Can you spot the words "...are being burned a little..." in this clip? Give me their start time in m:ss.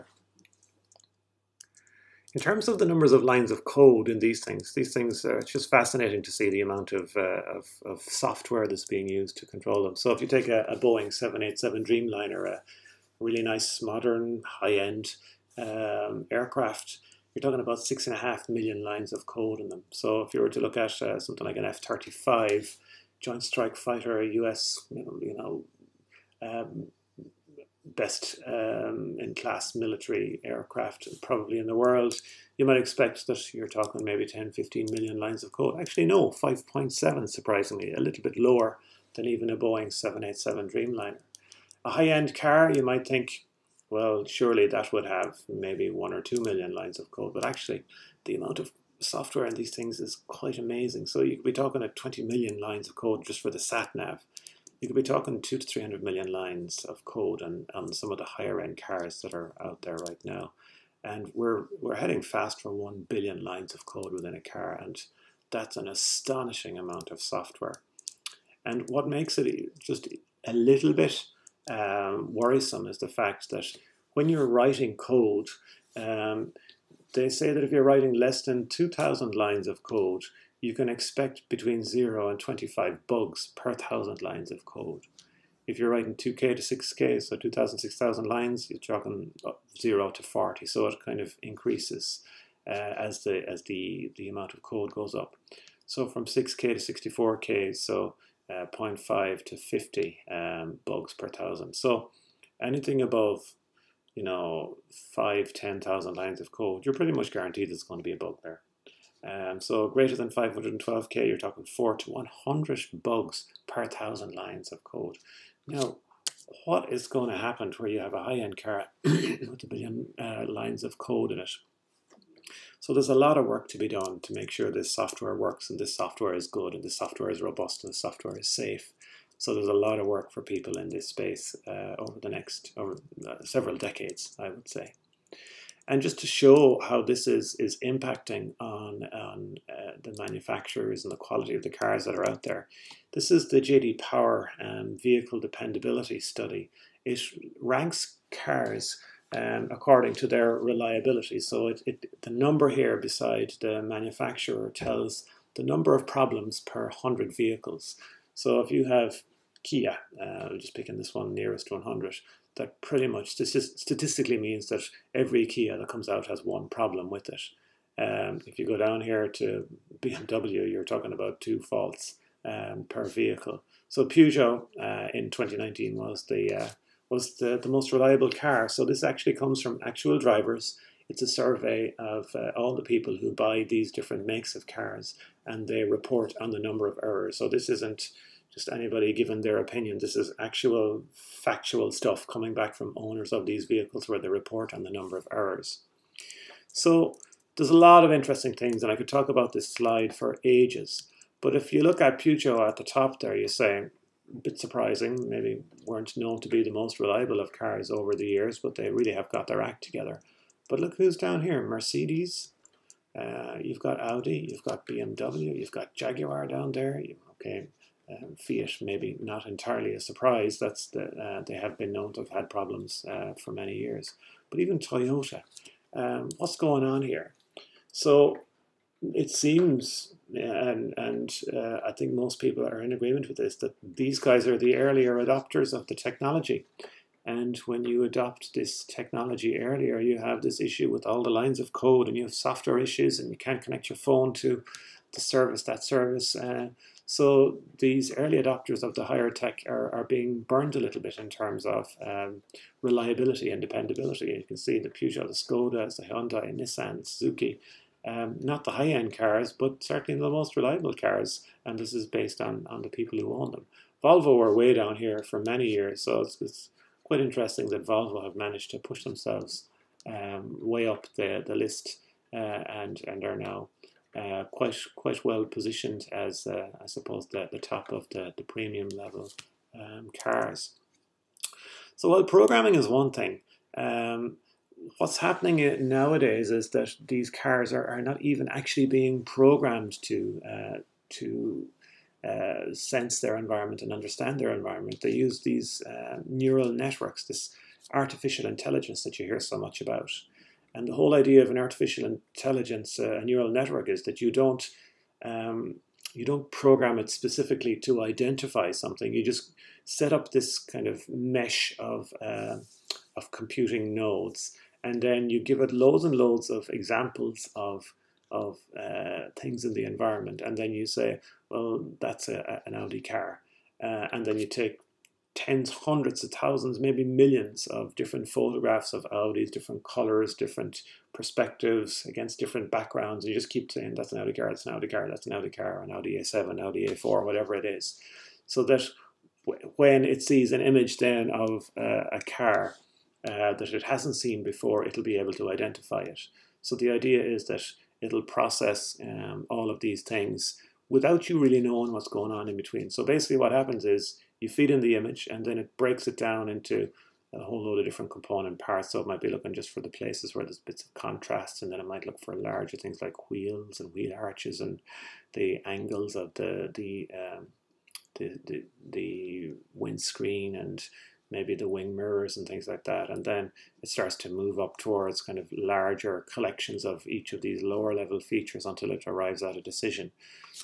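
4:09.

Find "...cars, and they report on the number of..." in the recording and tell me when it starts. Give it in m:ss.
3:04.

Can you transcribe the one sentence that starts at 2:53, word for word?
So Peugeot uh, in 2019 was the uh, was the, the most reliable car.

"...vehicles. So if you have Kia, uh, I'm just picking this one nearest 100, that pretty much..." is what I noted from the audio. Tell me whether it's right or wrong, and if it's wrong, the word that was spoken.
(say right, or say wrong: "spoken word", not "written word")
right.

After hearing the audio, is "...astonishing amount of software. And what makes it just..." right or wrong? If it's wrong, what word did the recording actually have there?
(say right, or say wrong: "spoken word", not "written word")
right.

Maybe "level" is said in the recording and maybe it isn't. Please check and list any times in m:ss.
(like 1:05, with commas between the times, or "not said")
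4:38, 6:17.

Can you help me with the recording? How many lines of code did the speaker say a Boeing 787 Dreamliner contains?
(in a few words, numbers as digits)
6.5 million.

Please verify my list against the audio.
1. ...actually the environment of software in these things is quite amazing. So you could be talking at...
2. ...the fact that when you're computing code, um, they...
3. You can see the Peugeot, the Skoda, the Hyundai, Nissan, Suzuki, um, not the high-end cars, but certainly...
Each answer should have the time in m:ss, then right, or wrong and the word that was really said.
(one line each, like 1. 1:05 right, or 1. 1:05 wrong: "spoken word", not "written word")
1. 0:47 wrong: "amount", not "environment"
2. 1:12 wrong: "writing", not "computing"
3. 4:14 right.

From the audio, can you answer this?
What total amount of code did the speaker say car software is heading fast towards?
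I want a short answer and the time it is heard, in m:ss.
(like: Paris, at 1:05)
1 billion lines, at 1:02.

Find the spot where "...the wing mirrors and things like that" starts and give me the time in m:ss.
6:11.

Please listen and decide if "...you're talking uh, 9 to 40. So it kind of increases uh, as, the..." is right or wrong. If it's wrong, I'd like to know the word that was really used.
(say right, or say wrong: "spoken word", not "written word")
wrong: "0", not "9".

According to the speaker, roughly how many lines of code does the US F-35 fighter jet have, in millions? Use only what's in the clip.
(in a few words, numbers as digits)
5.7 million.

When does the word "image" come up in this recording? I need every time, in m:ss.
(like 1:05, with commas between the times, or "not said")
5:40, 5:54.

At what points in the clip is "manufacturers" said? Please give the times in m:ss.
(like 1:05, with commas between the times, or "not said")
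2:20, 2:33.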